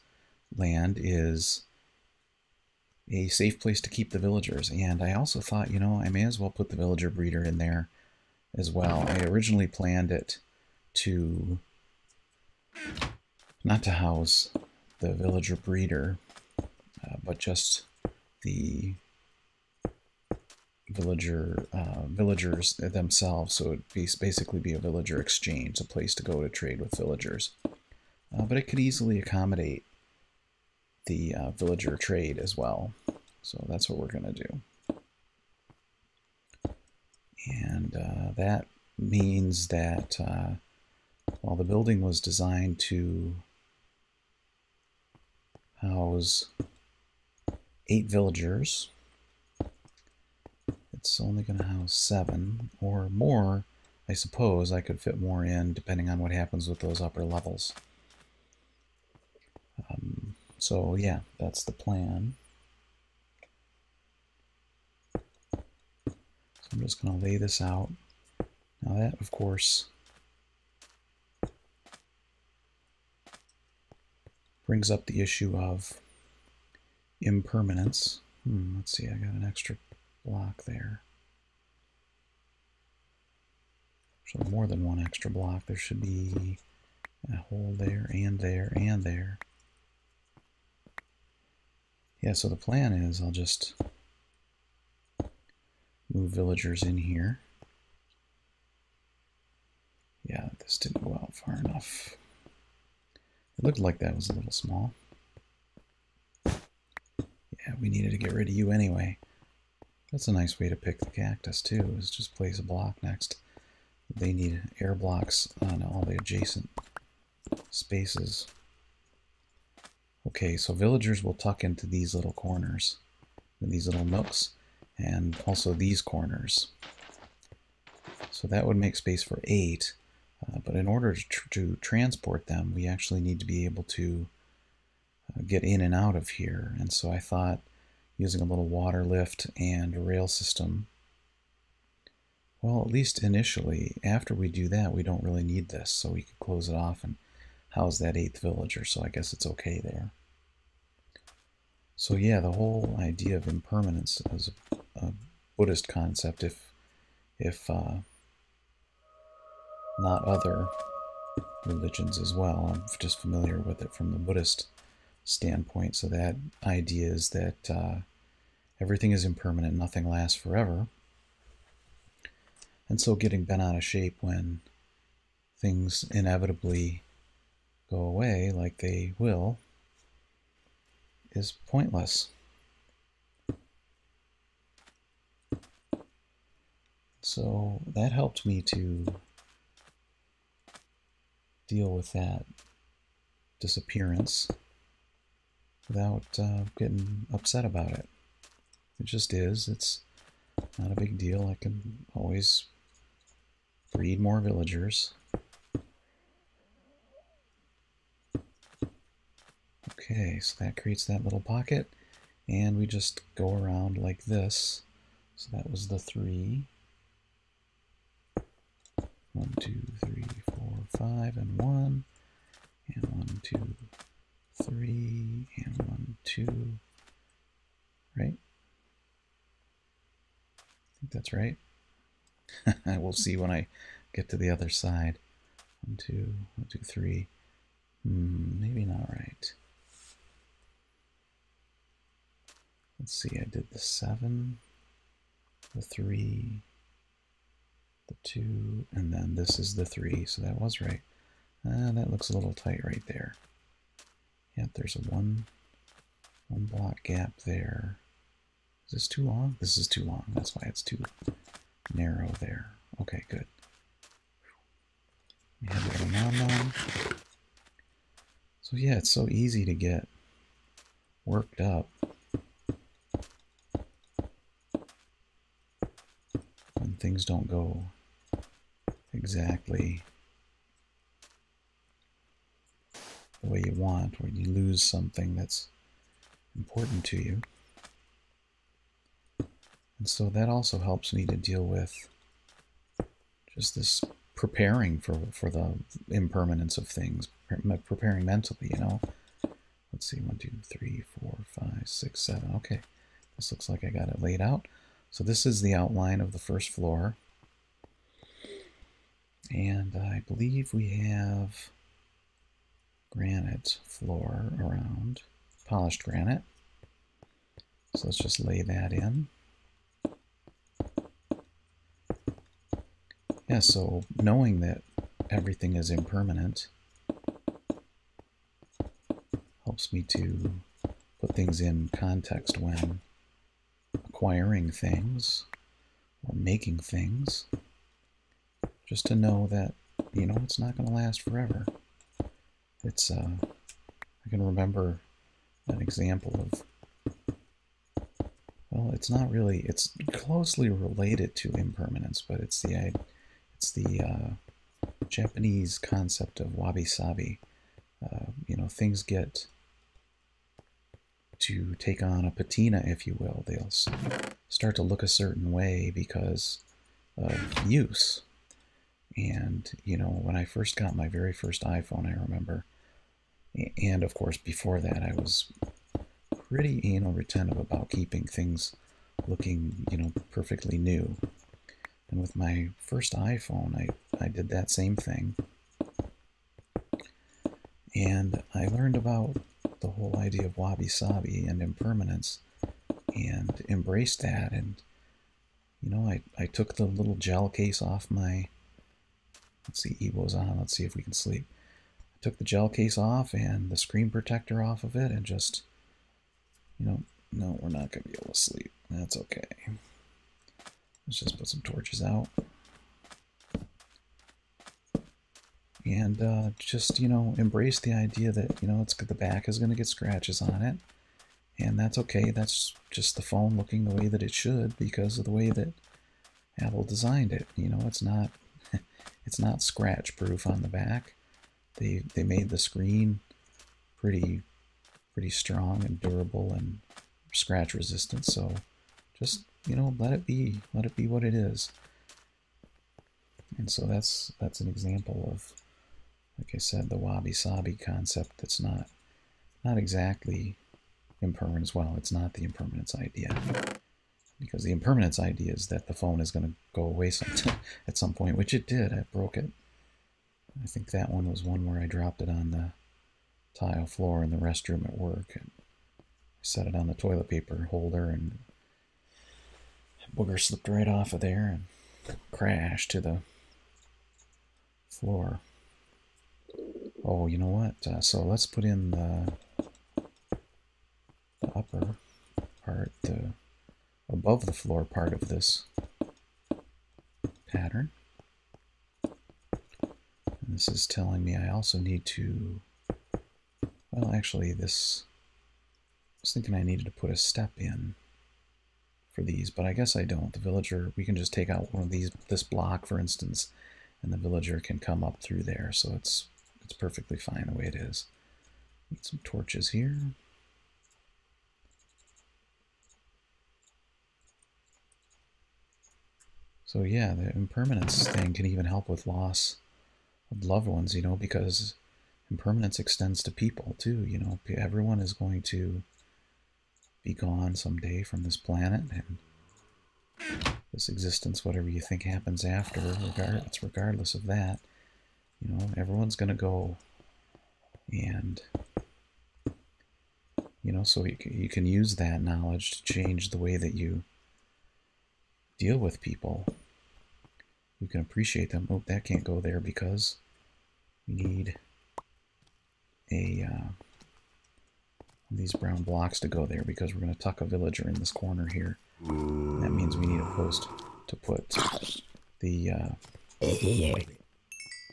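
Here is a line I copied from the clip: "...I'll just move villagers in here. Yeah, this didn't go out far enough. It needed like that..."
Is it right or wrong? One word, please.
wrong.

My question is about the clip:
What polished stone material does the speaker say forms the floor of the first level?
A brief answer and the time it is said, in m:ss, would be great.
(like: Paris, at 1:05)
Polished granite, at 5:15.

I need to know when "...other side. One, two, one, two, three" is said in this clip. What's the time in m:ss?
3:54.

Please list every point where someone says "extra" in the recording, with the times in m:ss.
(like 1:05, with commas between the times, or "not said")
1:19, 1:24.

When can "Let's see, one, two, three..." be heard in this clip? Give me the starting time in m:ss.
4:59.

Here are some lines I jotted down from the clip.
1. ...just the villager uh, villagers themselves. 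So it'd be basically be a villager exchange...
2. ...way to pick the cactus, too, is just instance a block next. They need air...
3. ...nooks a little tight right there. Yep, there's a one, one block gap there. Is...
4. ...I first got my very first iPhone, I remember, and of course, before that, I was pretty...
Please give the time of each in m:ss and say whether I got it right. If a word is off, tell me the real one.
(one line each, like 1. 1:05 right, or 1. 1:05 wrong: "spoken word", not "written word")
1. 0:17 right
2. 1:50 wrong: "place", not "instance"
3. 4:12 wrong: "looks", not "nooks"
4. 6:10 right.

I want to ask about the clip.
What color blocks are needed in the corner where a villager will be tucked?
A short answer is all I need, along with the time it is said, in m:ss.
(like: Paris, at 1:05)
Brown, at 9:15.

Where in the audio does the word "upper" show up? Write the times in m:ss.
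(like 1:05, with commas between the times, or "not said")
0:56, 8:01.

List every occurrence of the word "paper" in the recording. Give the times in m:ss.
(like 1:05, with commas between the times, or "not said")
7:47.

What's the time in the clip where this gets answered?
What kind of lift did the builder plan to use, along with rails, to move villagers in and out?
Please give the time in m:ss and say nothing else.
2:18.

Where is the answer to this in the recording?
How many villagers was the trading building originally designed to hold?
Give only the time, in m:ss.
0:47.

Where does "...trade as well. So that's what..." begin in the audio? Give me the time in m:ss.
0:31.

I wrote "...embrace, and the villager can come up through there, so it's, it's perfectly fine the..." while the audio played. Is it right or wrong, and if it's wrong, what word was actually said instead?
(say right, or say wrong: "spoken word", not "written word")
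wrong: "instance", not "embrace".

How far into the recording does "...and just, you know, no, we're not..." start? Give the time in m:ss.
6:45.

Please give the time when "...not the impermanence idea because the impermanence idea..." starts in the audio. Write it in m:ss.
7:32.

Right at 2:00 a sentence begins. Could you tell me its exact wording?
Okay, so villagers will tuck into these little corners, these little nooks, and also these corners.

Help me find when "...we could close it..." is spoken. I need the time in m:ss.
2:26.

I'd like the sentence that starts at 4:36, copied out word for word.
when things don't go exactly the way you want when you lose something that's important to you.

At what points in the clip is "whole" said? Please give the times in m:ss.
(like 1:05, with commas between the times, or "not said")
2:32, 6:29.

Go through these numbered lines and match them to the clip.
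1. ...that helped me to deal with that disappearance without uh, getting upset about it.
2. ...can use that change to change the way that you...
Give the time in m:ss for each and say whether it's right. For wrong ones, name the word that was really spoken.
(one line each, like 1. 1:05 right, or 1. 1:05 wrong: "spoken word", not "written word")
1. 3:07 right
2. 9:01 wrong: "knowledge", not "change".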